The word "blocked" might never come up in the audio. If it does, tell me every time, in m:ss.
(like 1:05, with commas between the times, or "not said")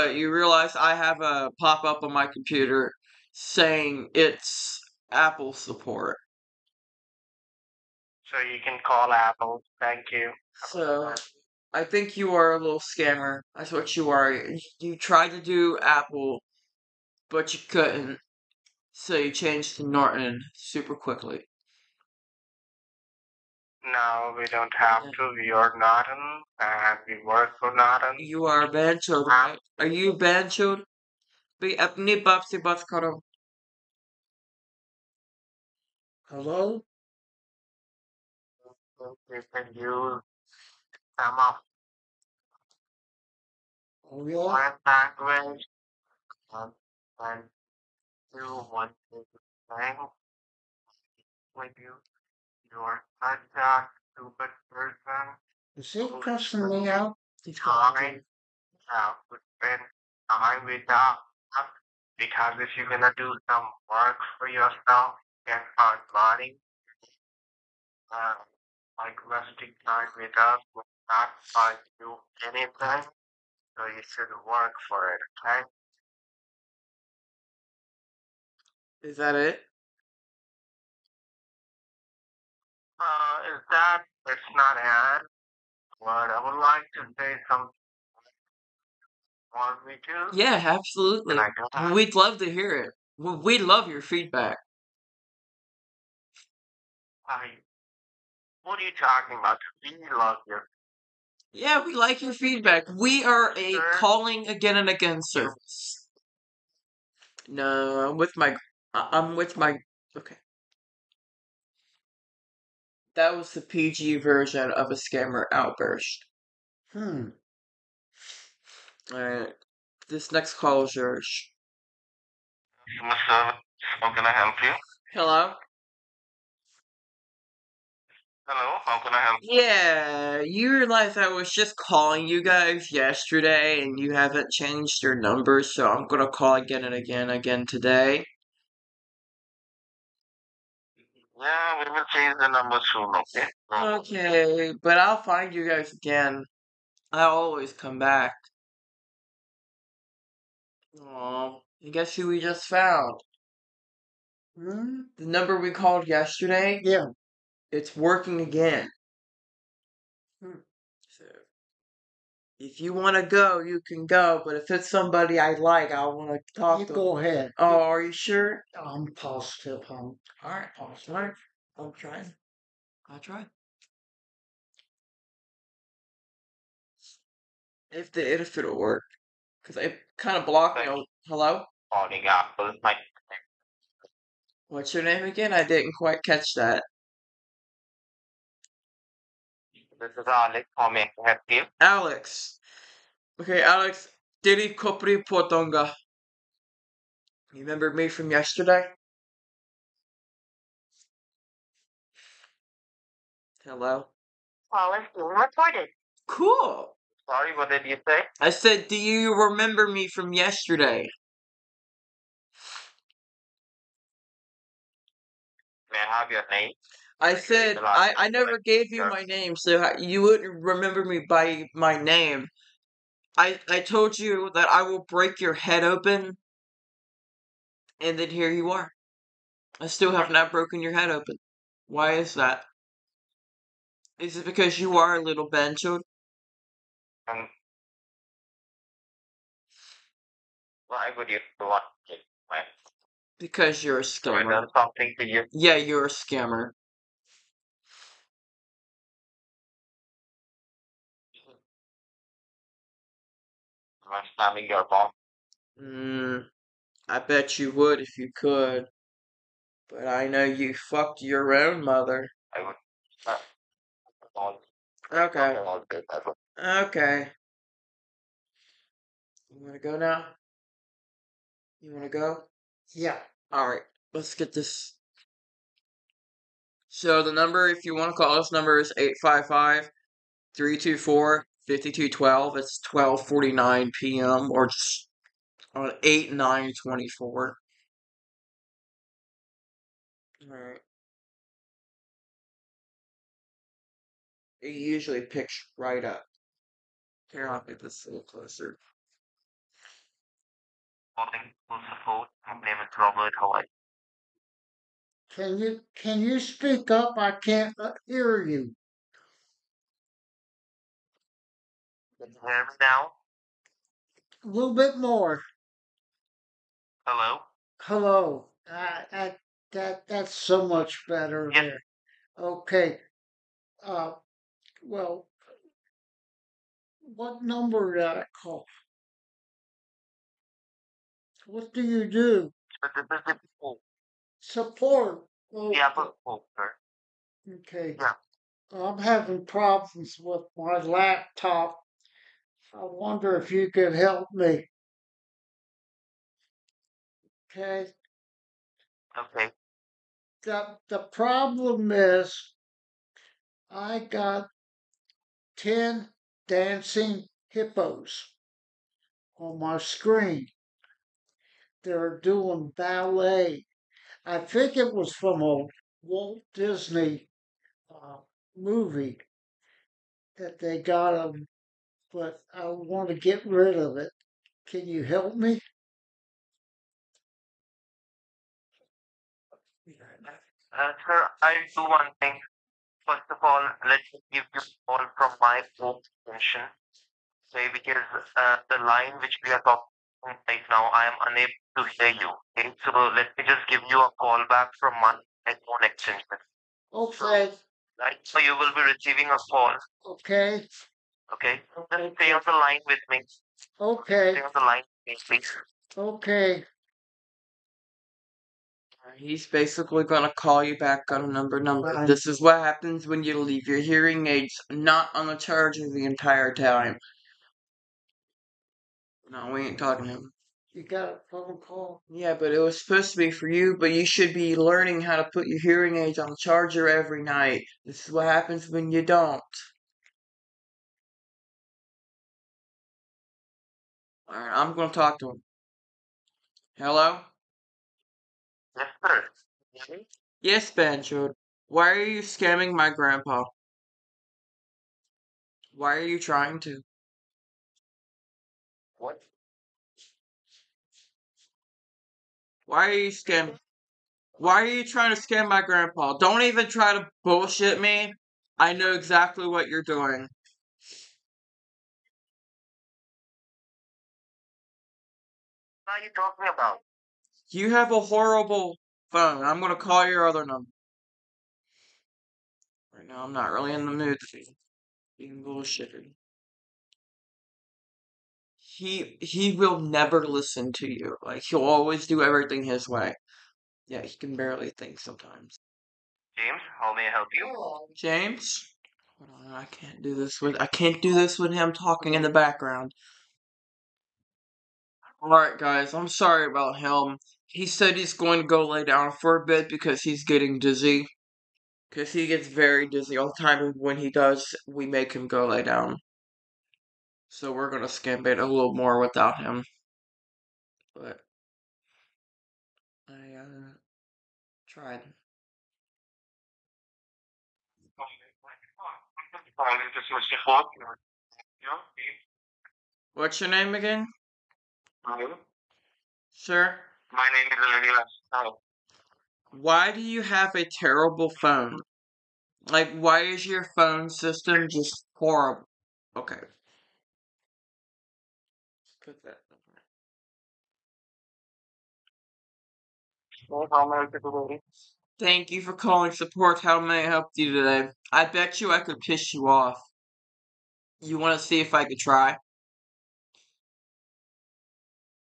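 3:00.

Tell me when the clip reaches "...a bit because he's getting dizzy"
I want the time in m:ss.
8:19.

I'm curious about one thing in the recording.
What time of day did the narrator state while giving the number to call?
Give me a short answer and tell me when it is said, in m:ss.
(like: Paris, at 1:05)
12:49 p.m., at 4:42.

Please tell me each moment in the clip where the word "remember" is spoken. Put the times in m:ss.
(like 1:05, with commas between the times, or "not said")
3:17, 3:29, 3:40.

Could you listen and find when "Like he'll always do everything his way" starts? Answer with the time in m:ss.
8:01.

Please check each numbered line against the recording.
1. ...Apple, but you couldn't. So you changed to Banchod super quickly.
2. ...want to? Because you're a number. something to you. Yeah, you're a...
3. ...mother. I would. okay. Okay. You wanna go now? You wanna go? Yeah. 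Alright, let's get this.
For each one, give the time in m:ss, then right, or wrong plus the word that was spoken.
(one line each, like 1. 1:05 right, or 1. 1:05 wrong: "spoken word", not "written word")
1. 0:15 wrong: "Norton", not "Banchod"
2. 4:01 wrong: "scammer", not "number"
3. 4:21 right.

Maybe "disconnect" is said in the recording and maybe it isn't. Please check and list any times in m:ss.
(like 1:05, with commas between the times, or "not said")
not said.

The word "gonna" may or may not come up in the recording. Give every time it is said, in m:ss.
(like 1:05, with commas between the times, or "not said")
1:02, 2:16, 7:14, 7:49.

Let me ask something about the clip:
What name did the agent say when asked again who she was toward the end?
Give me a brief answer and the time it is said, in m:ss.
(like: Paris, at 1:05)
Olivia, at 8:47.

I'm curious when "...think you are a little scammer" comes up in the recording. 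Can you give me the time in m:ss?
0:11.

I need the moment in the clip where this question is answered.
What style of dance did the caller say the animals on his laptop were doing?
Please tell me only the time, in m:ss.
6:02.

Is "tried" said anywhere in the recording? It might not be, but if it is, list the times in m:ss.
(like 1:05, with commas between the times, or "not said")
0:14, 8:34.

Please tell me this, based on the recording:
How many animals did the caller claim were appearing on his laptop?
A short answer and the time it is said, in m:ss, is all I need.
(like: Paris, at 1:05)
10, at 5:55.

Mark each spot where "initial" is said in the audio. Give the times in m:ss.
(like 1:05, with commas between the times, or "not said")
not said.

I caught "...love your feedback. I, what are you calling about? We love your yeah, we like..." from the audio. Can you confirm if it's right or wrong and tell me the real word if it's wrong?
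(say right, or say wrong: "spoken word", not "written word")
wrong: "talking", not "calling".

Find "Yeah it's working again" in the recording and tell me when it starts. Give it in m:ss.
2:36.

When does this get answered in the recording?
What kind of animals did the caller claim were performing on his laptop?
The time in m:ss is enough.
5:57.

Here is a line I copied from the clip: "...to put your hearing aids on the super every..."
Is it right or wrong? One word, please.
wrong.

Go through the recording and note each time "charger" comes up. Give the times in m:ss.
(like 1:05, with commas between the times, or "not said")
6:55, 7:06.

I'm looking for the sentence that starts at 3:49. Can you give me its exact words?
I still have not broken your head open.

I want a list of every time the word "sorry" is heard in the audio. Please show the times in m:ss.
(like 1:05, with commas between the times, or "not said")
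0:57, 3:27, 8:16.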